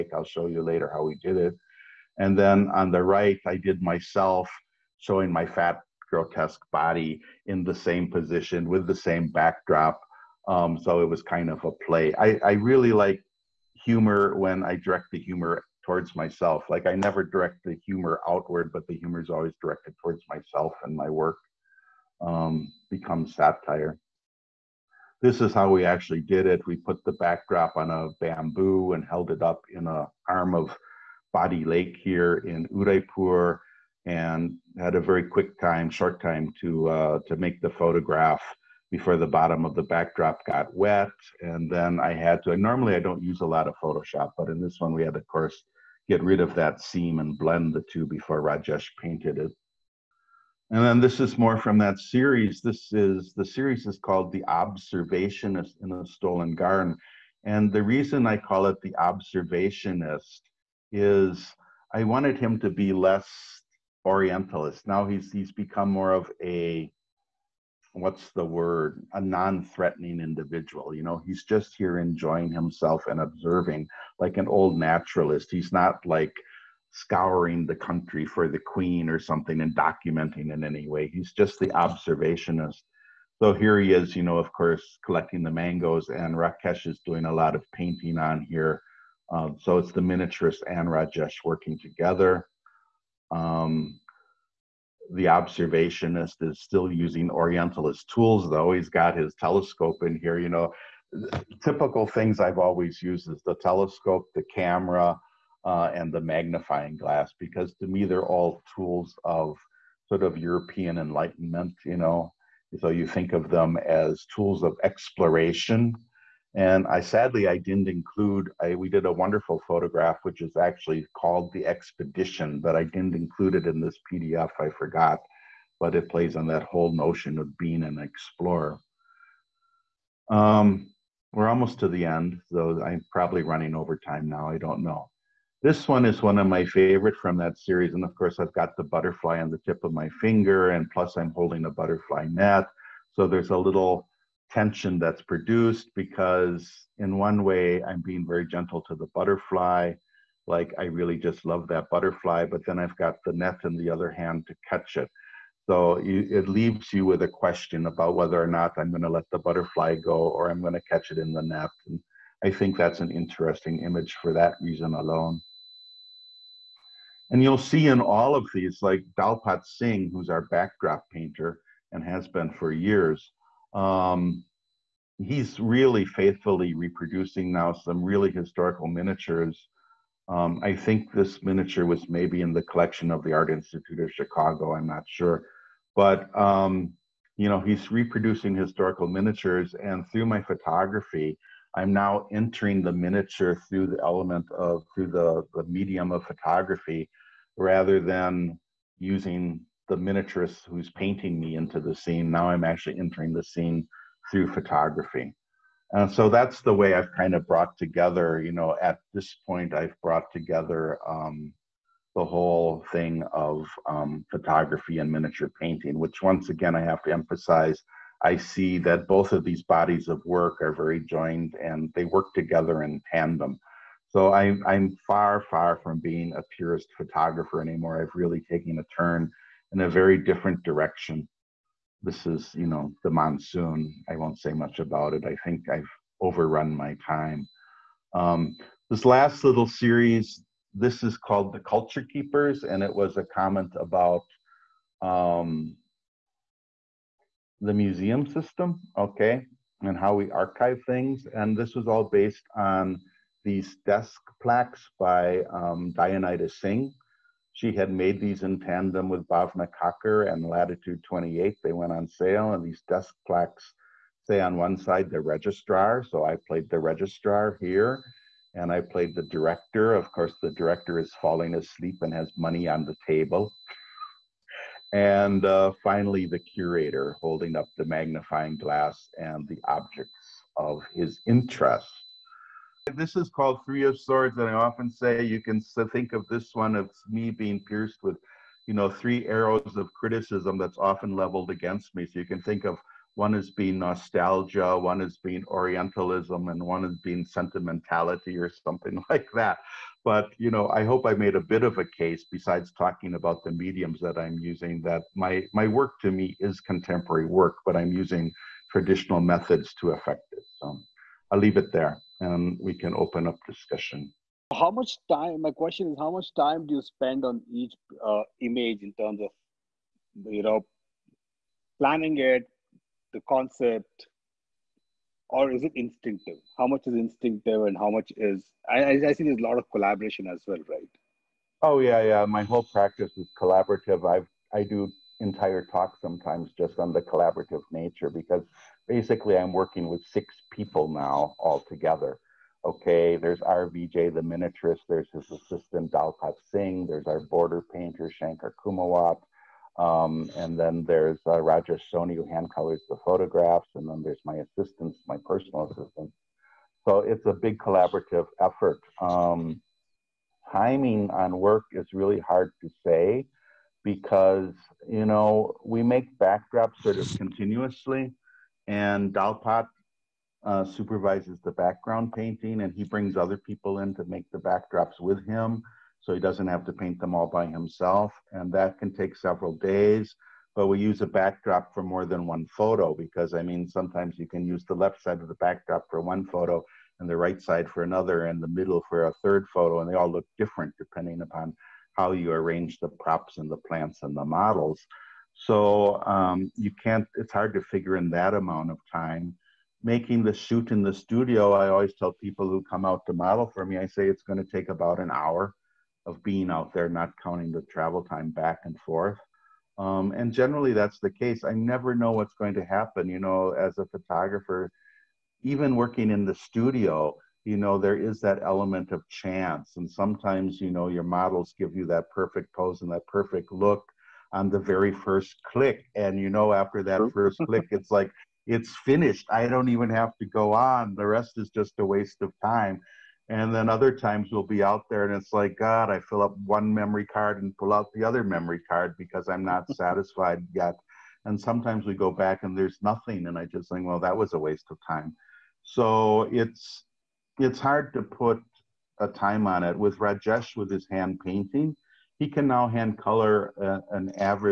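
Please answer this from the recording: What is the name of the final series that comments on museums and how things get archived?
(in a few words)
The Culture Keepers.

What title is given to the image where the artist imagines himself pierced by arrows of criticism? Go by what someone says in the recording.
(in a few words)
Three of Swords.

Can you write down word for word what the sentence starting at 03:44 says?
So I, I'm far, far from being a purist photographer anymore.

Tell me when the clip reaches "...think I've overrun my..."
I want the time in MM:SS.
03:55.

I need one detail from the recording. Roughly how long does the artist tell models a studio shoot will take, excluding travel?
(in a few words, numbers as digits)
about an hour.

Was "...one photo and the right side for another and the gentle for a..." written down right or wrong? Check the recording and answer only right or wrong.
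wrong.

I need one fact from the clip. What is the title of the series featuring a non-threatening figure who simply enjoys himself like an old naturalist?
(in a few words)
The Observationist in the Stolen Garden.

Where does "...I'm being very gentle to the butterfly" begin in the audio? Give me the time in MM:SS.
02:27.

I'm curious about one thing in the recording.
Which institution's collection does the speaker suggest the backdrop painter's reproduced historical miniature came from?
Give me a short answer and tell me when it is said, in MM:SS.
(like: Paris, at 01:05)
Art Institute of Chicago, at 03:03.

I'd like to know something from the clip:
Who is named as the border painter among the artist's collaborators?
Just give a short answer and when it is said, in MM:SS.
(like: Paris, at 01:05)
Shankar Kumawat, at 05:48.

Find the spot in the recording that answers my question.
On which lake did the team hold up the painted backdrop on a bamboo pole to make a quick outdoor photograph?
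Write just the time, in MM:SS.
00:31.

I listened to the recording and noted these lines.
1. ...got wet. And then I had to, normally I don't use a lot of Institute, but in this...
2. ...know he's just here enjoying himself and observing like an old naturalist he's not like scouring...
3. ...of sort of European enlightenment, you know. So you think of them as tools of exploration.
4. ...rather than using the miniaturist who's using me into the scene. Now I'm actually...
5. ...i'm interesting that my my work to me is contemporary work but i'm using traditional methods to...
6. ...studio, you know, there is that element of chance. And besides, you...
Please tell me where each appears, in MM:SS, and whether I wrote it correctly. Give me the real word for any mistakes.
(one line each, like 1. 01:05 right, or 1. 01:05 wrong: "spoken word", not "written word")
1. 00:40 wrong: "Photoshop", not "Institute"
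2. 01:11 right
3. 01:49 right
4. 03:17 wrong: "painting", not "using"
5. 05:04 wrong: "using", not "interesting"
6. 06:56 wrong: "sometimes", not "besides".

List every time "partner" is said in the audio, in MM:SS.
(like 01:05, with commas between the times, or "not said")
not said.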